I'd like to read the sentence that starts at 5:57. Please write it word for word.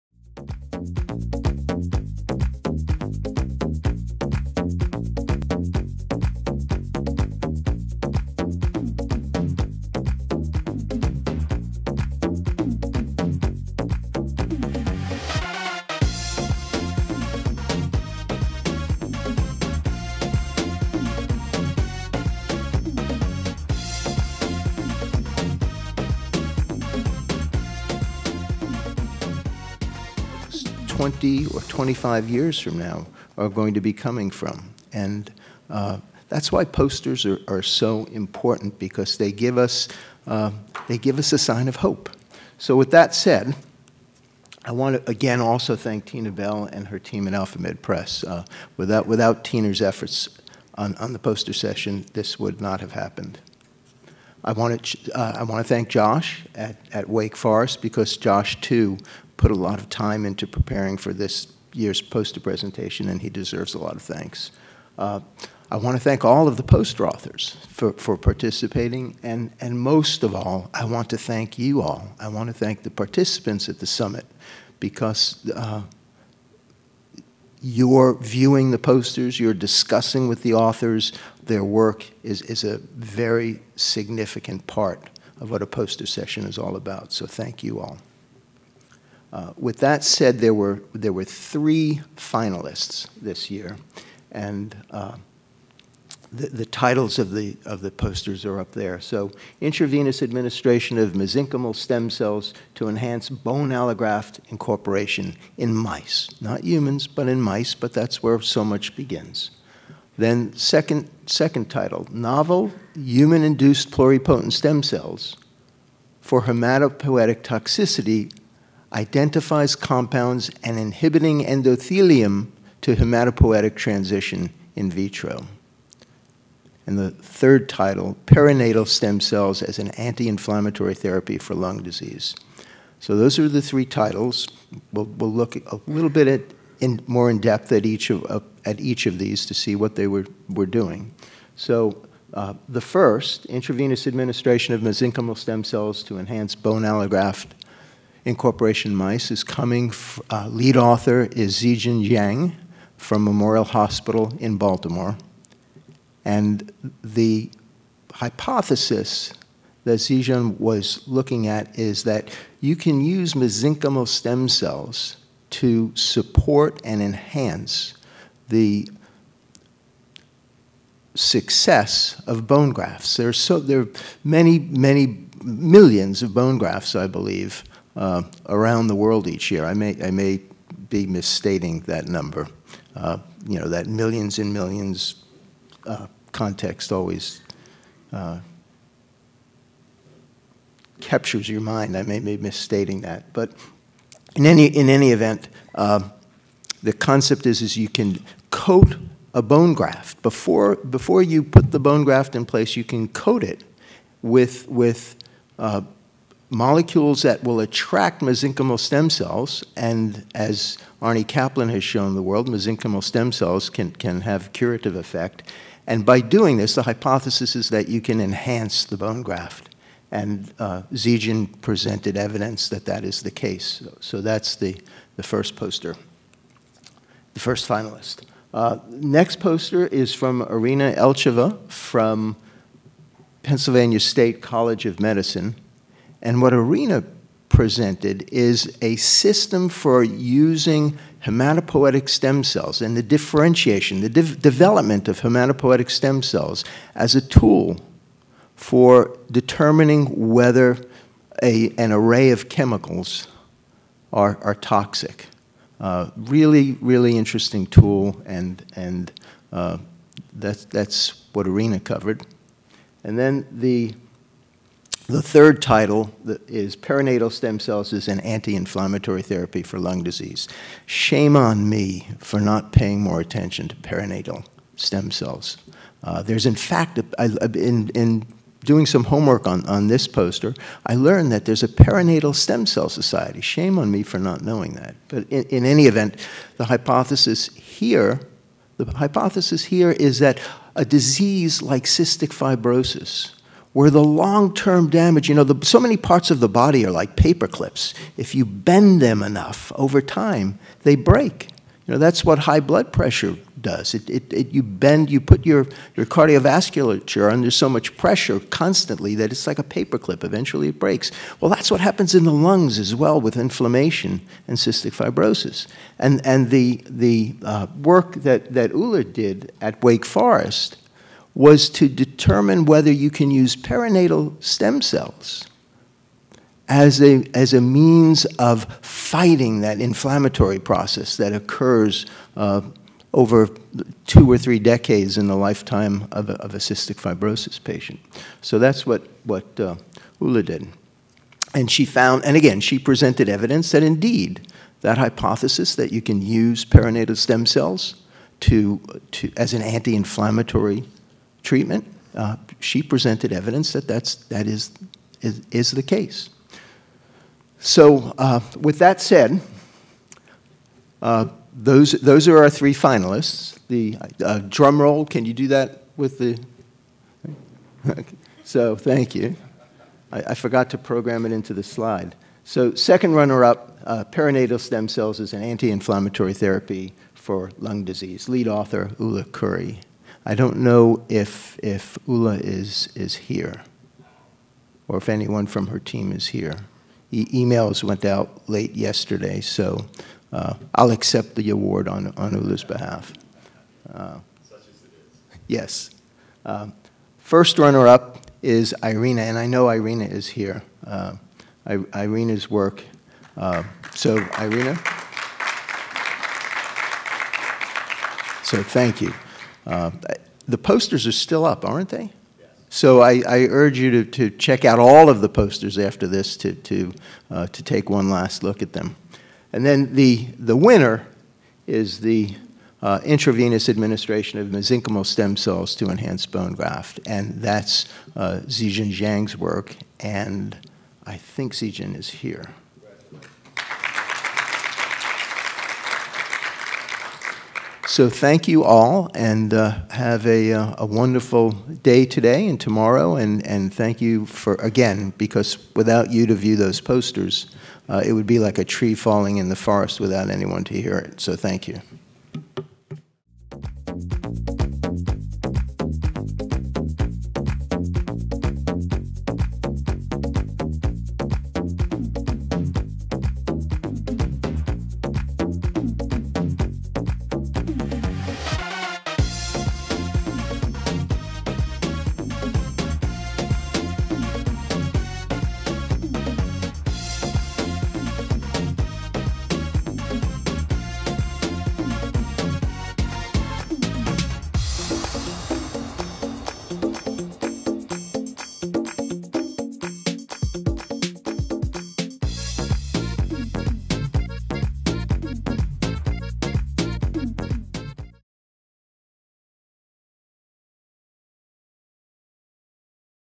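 So, uh, with that said, uh, those, those are our three finalists.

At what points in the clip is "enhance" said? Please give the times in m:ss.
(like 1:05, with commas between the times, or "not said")
1:42, 2:26, 2:47, 3:38, 7:05.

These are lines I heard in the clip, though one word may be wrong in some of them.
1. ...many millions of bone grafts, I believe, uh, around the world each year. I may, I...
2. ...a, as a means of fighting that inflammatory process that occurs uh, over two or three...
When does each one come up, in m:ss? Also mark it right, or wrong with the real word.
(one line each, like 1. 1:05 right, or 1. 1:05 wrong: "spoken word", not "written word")
1. 2:54 right
2. 5:27 right.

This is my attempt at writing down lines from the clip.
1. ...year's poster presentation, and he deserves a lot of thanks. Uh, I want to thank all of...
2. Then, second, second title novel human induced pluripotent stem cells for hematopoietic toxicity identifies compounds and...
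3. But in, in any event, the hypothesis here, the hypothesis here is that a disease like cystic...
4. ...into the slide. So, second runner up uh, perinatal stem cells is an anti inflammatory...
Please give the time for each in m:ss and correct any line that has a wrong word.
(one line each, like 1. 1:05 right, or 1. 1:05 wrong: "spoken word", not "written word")
1. 1:01 right
2. 1:50 right
3. 4:45 right
4. 6:11 right.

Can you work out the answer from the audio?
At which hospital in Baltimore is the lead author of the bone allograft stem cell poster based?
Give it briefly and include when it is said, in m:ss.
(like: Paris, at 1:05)
Memorial Hospital, at 2:33.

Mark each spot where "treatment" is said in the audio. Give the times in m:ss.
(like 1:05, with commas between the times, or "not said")
5:51.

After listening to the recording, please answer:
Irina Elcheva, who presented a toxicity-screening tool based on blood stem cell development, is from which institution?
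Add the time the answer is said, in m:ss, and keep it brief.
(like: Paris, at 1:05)
Pennsylvania State College of Medicine, at 3:53.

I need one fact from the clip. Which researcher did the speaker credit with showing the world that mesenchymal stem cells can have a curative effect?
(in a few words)
Arnie Caplan.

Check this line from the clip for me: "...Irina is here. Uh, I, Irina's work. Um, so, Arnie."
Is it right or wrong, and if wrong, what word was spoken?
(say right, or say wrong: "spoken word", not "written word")
wrong: "Irina", not "Arnie".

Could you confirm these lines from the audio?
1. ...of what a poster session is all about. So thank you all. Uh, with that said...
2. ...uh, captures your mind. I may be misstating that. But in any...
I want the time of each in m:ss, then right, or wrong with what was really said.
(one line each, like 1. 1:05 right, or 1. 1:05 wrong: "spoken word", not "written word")
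1. 1:25 right
2. 3:08 right.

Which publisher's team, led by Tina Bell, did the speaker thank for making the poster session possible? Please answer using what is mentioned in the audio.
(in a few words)
AlphaMed Press.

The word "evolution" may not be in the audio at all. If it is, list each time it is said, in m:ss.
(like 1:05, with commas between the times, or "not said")
not said.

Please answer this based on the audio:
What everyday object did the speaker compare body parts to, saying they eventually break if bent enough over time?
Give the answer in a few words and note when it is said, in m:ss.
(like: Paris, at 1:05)
Paper clips, at 4:57.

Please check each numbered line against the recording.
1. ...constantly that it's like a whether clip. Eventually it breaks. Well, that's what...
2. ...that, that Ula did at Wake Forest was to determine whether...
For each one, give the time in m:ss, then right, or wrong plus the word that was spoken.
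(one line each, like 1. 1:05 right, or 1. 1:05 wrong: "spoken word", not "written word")
1. 5:08 wrong: "paper", not "whether"
2. 5:18 right.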